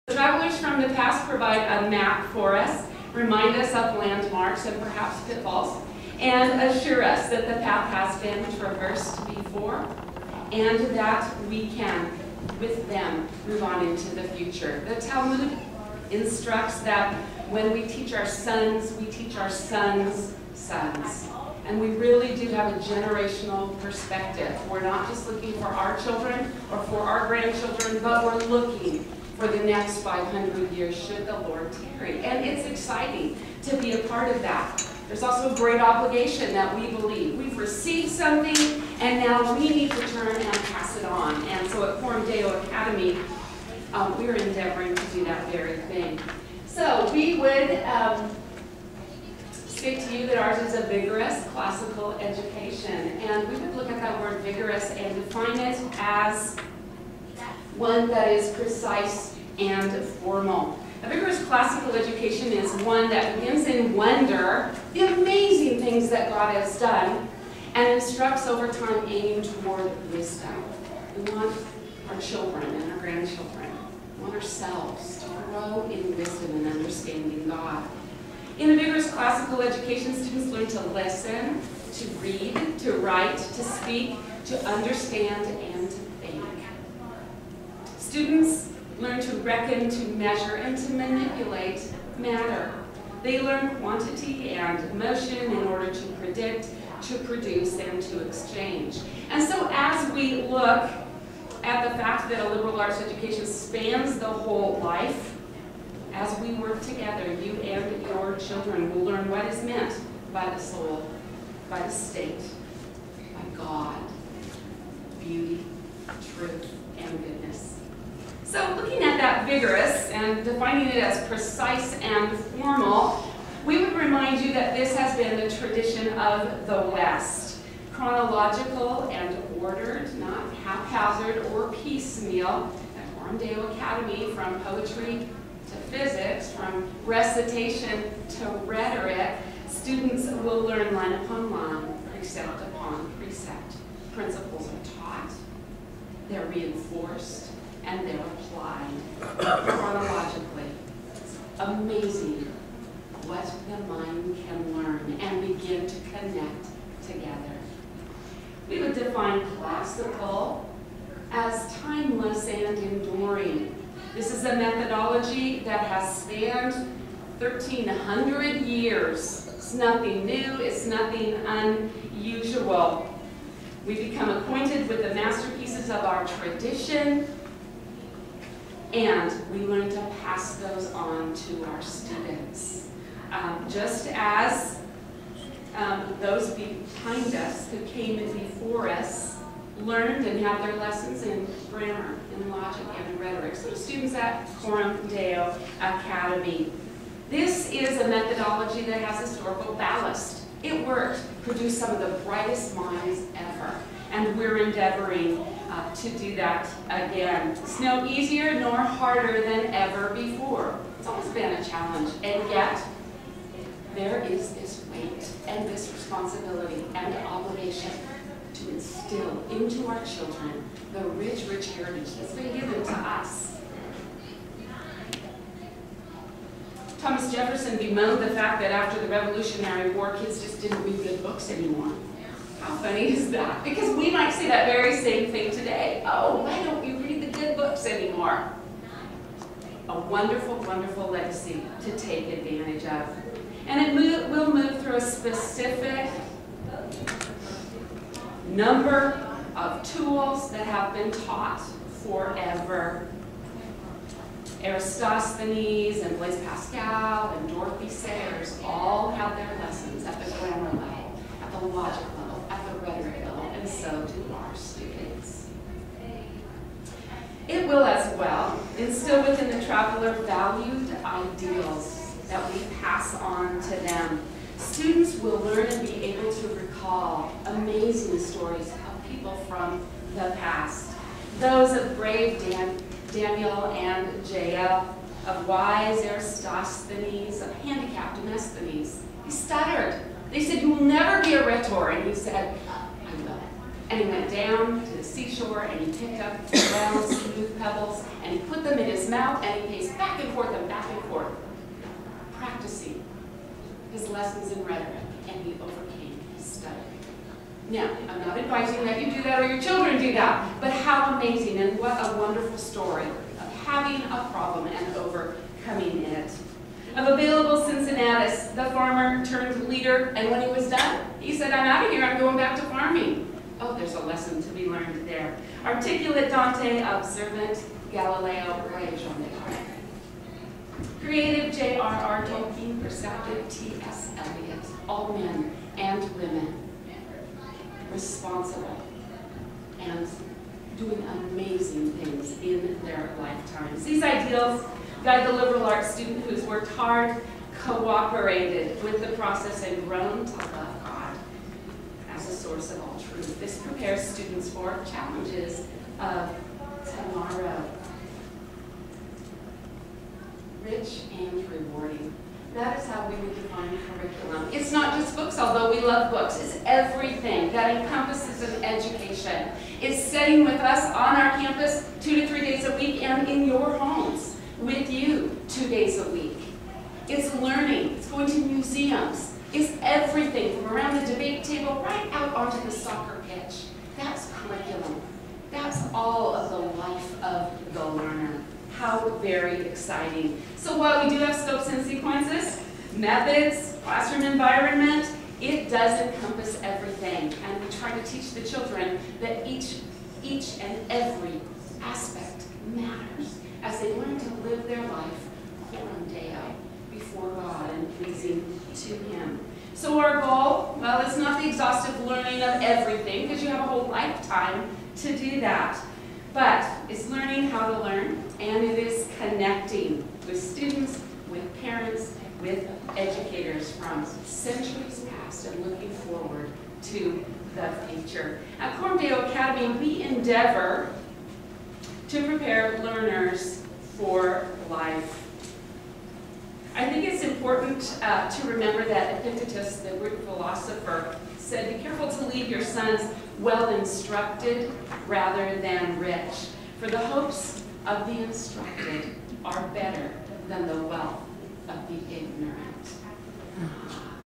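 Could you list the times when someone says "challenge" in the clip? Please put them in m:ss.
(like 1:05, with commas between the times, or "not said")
3:31, 5:54.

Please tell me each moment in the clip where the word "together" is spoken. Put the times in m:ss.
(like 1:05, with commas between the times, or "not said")
1:46, 2:37.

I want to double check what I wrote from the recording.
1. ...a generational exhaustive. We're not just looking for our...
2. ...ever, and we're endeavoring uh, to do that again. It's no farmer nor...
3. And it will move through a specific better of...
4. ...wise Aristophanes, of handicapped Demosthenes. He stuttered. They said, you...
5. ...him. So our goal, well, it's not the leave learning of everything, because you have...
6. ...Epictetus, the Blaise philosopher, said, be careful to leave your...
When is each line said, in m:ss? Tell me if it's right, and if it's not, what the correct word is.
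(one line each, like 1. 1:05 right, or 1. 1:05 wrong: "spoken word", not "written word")
1. 0:22 wrong: "perspective", not "exhaustive"
2. 3:23 wrong: "easier", not "farmer"
3. 4:03 wrong: "number", not "better"
4. 4:45 right
5. 6:49 wrong: "exhaustive", not "leave"
6. 7:19 wrong: "Greek", not "Blaise".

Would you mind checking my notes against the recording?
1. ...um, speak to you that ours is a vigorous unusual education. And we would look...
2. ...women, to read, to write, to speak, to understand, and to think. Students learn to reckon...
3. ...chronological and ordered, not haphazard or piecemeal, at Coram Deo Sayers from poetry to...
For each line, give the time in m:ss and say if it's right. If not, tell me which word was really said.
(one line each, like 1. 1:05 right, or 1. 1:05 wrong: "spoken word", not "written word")
1. 0:47 wrong: "classical", not "unusual"
2. 1:20 wrong: "listen", not "women"
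3. 2:07 wrong: "Academy", not "Sayers".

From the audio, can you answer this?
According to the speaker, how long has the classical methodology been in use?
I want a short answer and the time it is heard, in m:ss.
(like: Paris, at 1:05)
1,300 years, at 2:47.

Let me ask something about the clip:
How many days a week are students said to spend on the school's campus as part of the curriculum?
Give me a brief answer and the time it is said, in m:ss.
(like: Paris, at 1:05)
2 to 3 days, at 6:12.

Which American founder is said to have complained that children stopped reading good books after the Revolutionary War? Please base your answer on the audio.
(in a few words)
Jefferson.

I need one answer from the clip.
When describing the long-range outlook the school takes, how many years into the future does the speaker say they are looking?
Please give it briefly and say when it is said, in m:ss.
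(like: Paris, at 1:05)
500, at 0:30.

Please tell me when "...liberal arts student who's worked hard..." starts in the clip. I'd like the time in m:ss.
5:45.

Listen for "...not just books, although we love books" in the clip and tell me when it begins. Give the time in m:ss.
6:04.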